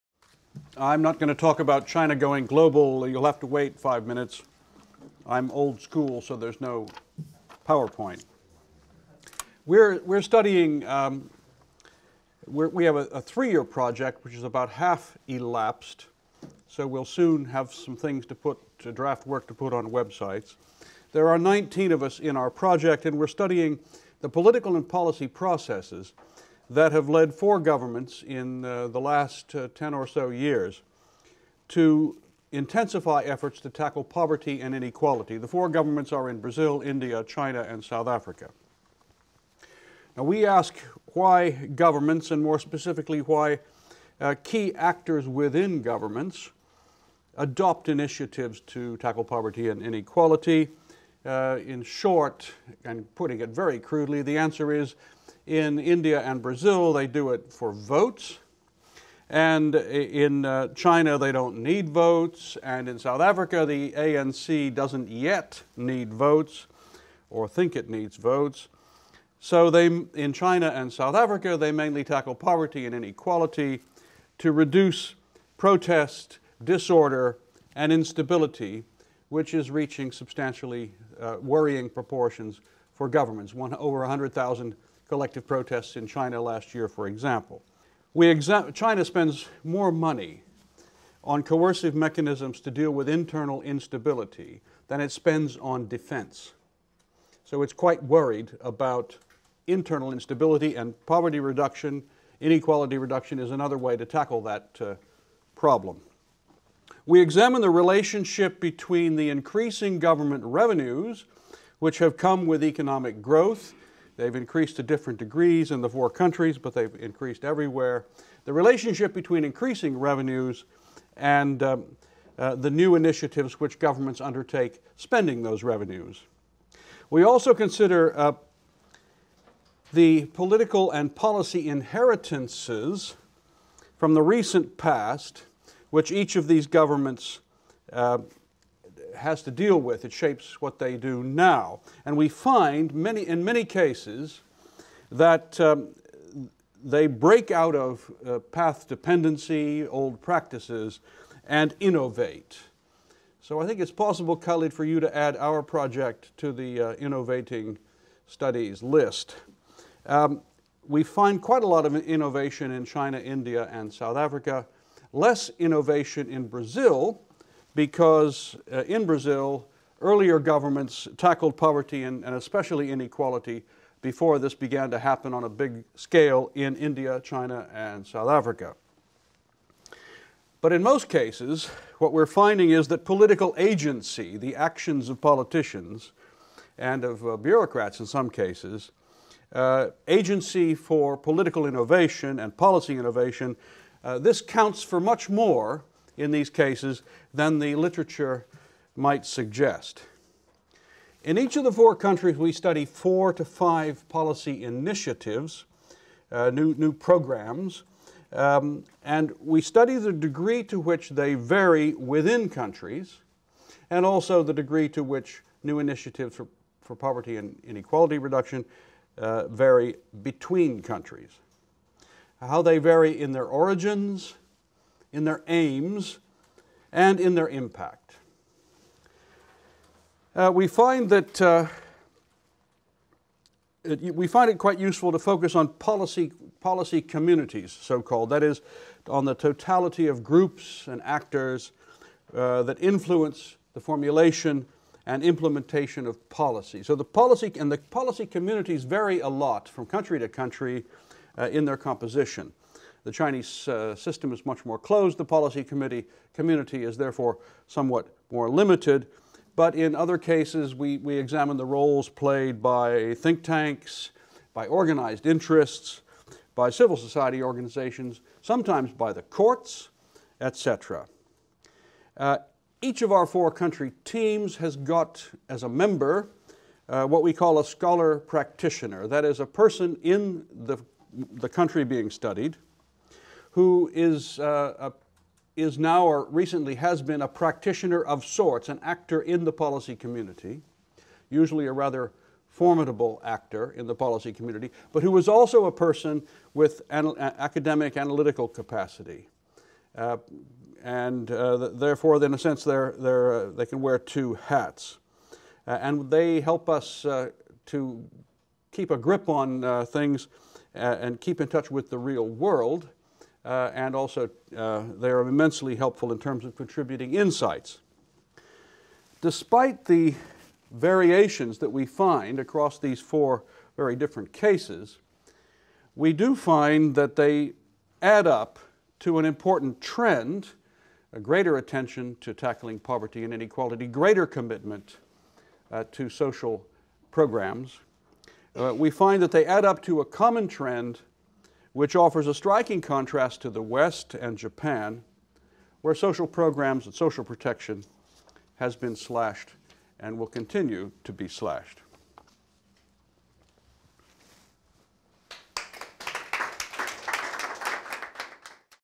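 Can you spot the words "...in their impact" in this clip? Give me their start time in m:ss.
3:47.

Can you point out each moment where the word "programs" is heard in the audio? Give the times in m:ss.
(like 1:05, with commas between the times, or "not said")
3:26, 5:37, 5:46.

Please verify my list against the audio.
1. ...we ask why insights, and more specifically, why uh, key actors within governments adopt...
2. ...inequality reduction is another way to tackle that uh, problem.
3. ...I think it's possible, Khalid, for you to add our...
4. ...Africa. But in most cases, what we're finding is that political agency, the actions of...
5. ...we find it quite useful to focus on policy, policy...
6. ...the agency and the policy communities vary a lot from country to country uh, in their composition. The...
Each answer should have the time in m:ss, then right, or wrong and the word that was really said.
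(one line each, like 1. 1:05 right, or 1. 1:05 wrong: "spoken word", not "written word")
1. 0:40 wrong: "governments", not "insights"
2. 1:42 right
3. 2:33 right
4. 2:58 right
5. 3:54 right
6. 4:06 wrong: "policy", not "agency".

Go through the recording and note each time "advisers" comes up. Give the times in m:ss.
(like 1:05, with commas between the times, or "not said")
not said.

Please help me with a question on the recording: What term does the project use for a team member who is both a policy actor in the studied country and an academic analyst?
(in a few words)
scholar practitioner.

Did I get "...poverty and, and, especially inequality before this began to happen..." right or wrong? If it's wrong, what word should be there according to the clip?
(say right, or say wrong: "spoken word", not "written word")
right.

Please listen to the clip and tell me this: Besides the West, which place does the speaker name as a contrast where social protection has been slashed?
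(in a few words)
Japan.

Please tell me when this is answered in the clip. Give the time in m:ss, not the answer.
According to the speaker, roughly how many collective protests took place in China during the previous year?
1:23.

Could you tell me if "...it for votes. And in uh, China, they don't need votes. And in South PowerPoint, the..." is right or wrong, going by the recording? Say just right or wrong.
wrong.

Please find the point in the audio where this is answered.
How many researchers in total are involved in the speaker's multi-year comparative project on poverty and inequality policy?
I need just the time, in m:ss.
0:21.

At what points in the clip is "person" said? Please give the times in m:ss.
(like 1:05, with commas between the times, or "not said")
4:39, 4:55.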